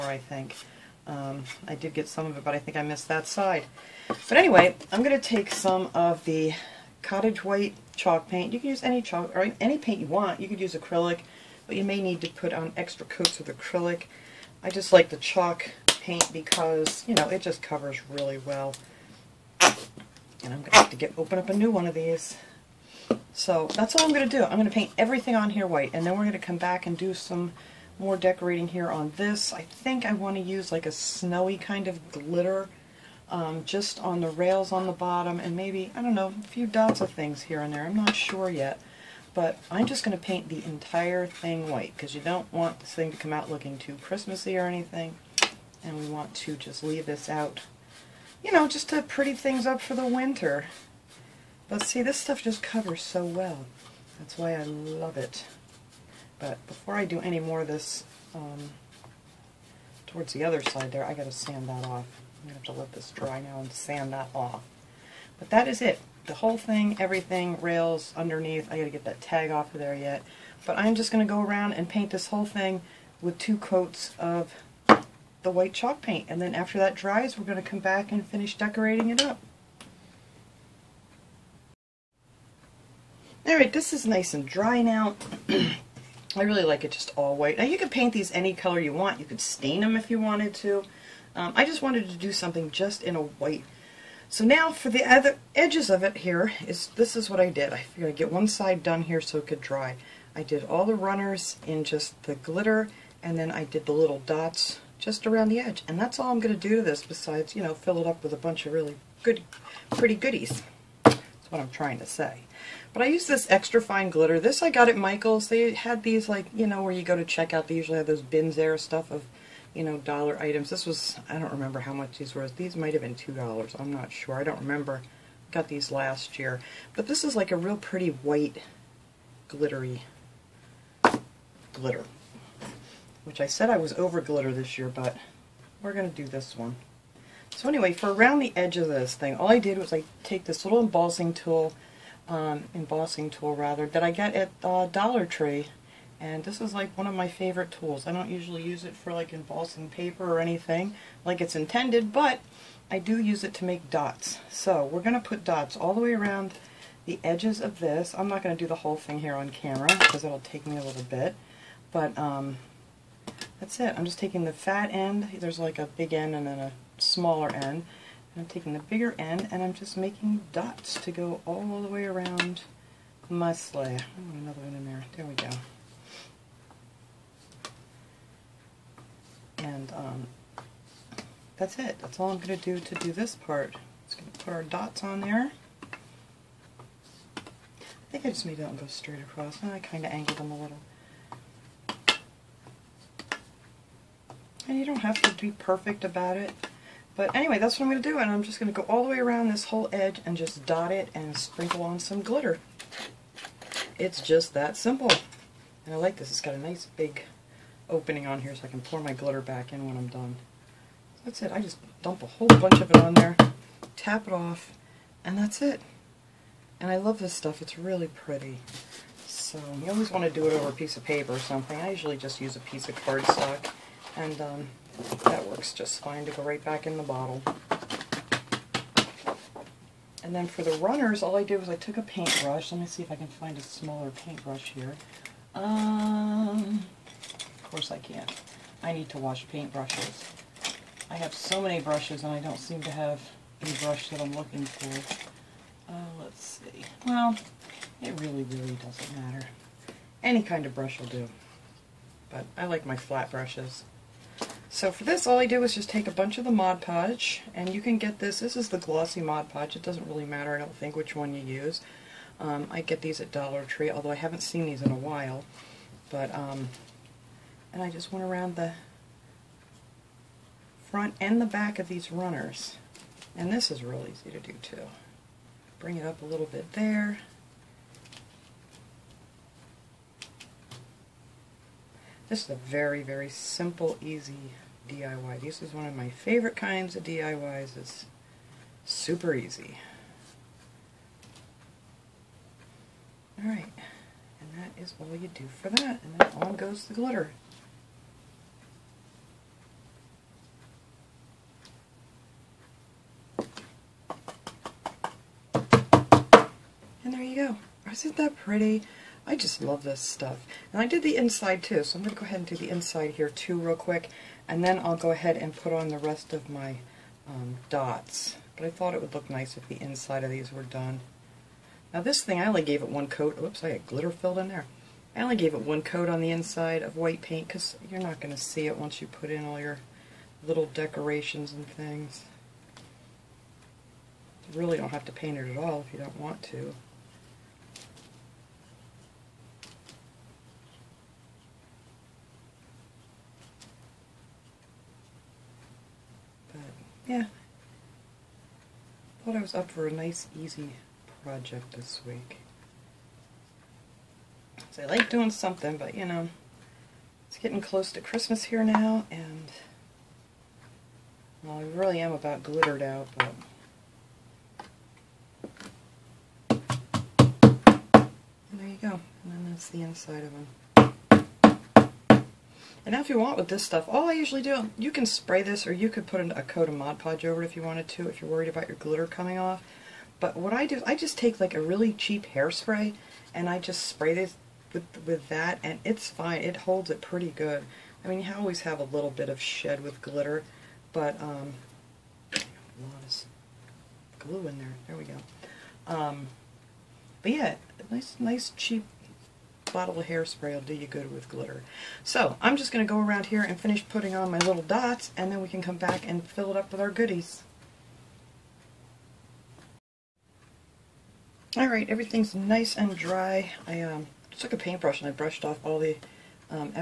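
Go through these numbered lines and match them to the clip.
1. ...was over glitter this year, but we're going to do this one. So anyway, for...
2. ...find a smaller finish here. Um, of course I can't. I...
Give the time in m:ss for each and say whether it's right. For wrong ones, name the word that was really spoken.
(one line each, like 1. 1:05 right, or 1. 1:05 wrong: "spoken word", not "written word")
1. 2:13 right
2. 3:53 wrong: "paintbrush", not "finish".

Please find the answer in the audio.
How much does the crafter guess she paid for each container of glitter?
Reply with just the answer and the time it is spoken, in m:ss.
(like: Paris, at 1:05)
$2, at 2:03.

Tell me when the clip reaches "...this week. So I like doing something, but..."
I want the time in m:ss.
5:51.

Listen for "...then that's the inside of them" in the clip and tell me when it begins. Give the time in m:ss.
6:09.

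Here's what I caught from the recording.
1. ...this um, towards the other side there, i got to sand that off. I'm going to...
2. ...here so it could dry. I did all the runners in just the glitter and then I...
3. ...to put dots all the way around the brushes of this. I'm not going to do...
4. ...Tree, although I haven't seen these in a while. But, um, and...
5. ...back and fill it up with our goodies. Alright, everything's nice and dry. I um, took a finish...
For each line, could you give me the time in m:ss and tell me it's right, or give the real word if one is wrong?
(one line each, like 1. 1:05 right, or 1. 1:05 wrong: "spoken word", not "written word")
1. 0:57 right
2. 1:39 right
3. 2:35 wrong: "edges", not "brushes"
4. 4:23 right
5. 6:45 wrong: "paintbrush", not "finish".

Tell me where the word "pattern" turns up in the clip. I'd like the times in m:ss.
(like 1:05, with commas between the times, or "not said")
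not said.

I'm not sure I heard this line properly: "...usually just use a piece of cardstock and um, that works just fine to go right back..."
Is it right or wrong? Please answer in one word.
right.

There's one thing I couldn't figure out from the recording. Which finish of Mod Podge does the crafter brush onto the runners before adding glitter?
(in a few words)
Glossy.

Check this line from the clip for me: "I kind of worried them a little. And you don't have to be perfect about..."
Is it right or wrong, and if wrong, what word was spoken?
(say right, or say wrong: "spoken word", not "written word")
wrong: "angled", not "worried".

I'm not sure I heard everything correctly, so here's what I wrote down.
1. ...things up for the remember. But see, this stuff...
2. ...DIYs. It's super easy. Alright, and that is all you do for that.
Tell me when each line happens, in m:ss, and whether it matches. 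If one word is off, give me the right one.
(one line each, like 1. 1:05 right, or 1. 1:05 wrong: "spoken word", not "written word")
1. 0:49 wrong: "winter", not "remember"
2. 4:47 right.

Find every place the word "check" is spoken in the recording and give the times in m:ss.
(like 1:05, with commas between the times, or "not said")
1:57.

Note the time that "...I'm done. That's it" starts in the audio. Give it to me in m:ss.
3:29.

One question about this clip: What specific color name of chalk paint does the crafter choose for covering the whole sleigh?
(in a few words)
Cottage white.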